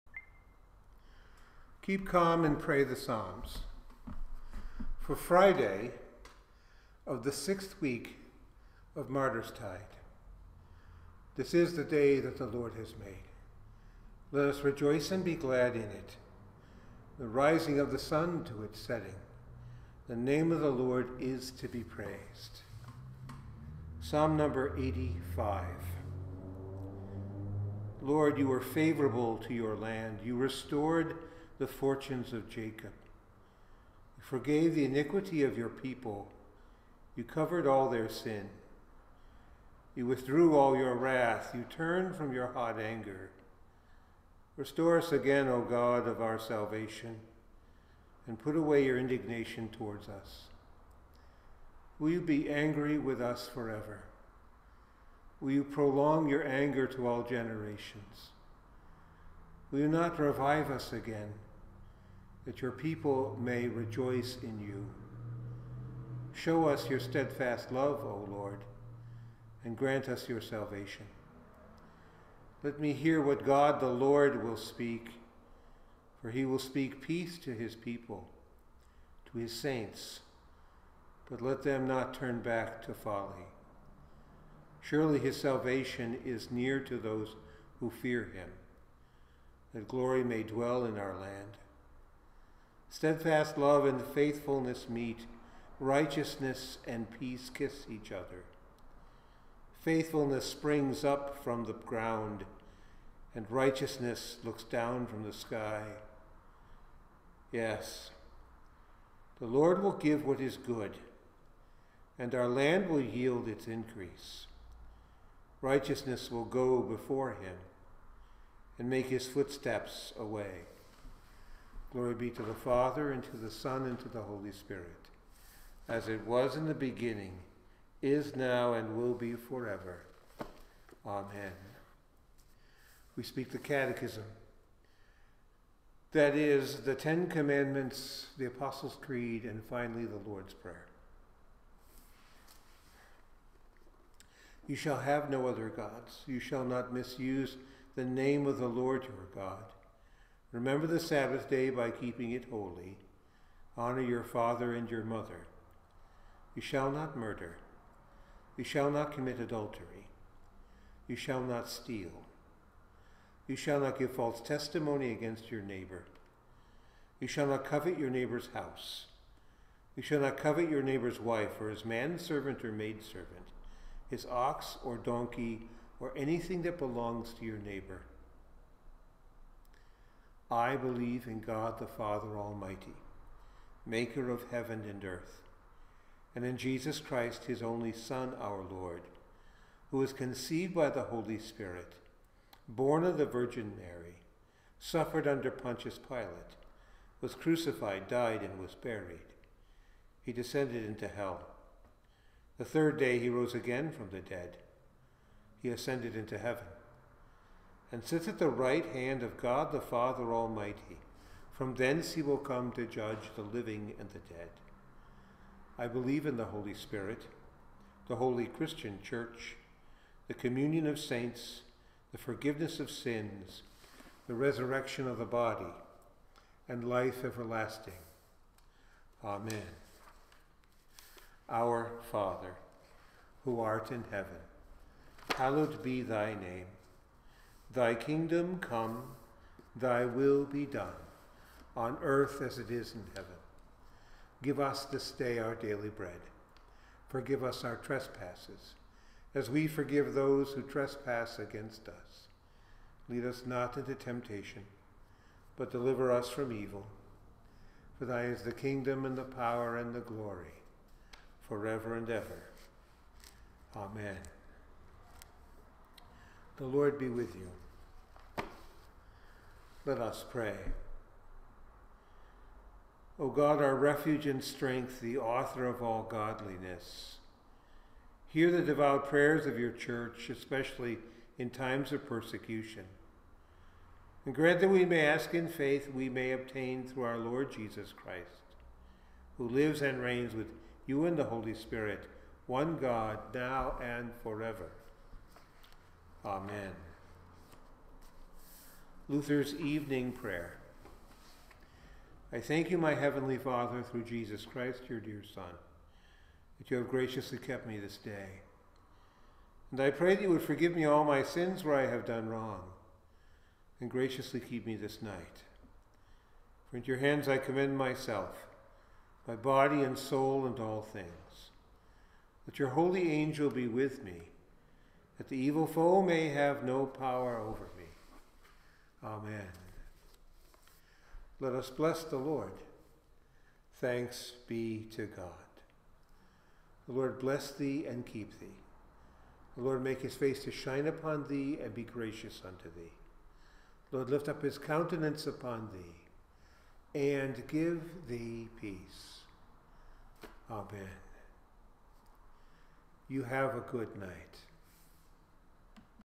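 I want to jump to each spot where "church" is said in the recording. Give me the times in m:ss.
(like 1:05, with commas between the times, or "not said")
3:39, 4:39.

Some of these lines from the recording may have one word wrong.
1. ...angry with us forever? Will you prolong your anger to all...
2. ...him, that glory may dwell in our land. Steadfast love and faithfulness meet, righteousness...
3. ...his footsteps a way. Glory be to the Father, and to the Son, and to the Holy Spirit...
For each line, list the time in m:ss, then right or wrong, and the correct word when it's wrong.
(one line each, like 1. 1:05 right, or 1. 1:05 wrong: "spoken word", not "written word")
1. 0:52 right
2. 1:28 right
3. 1:59 right.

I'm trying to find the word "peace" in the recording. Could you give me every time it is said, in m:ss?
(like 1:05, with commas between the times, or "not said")
1:17, 1:37, 5:48.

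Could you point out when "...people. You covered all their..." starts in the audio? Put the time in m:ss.
0:35.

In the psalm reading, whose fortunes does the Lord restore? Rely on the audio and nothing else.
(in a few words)
Jacob.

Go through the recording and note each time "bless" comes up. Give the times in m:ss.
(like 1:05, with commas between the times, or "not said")
5:31, 5:37.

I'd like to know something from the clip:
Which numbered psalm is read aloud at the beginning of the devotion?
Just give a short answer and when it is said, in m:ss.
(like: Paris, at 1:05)
85, at 0:24.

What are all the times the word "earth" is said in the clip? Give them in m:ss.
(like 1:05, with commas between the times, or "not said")
3:05, 4:02.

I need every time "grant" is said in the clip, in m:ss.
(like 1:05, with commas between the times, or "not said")
1:09, 4:44.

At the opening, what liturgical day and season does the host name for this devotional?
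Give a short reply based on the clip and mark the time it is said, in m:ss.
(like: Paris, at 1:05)
Friday of the sixth week of Martyr's Tide, at 0:05.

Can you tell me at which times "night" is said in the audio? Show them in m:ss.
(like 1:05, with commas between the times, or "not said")
5:15, 5:53.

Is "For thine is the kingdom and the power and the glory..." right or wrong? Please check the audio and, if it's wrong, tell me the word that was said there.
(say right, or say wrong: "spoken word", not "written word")
right.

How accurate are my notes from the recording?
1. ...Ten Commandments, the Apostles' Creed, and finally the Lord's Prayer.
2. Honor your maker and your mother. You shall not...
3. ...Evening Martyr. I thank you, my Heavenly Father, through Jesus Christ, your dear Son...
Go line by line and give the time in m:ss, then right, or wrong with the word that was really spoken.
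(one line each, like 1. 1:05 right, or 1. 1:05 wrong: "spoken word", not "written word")
1. 2:16 right
2. 2:33 wrong: "father", not "maker"
3. 4:59 wrong: "Prayer", not "Martyr".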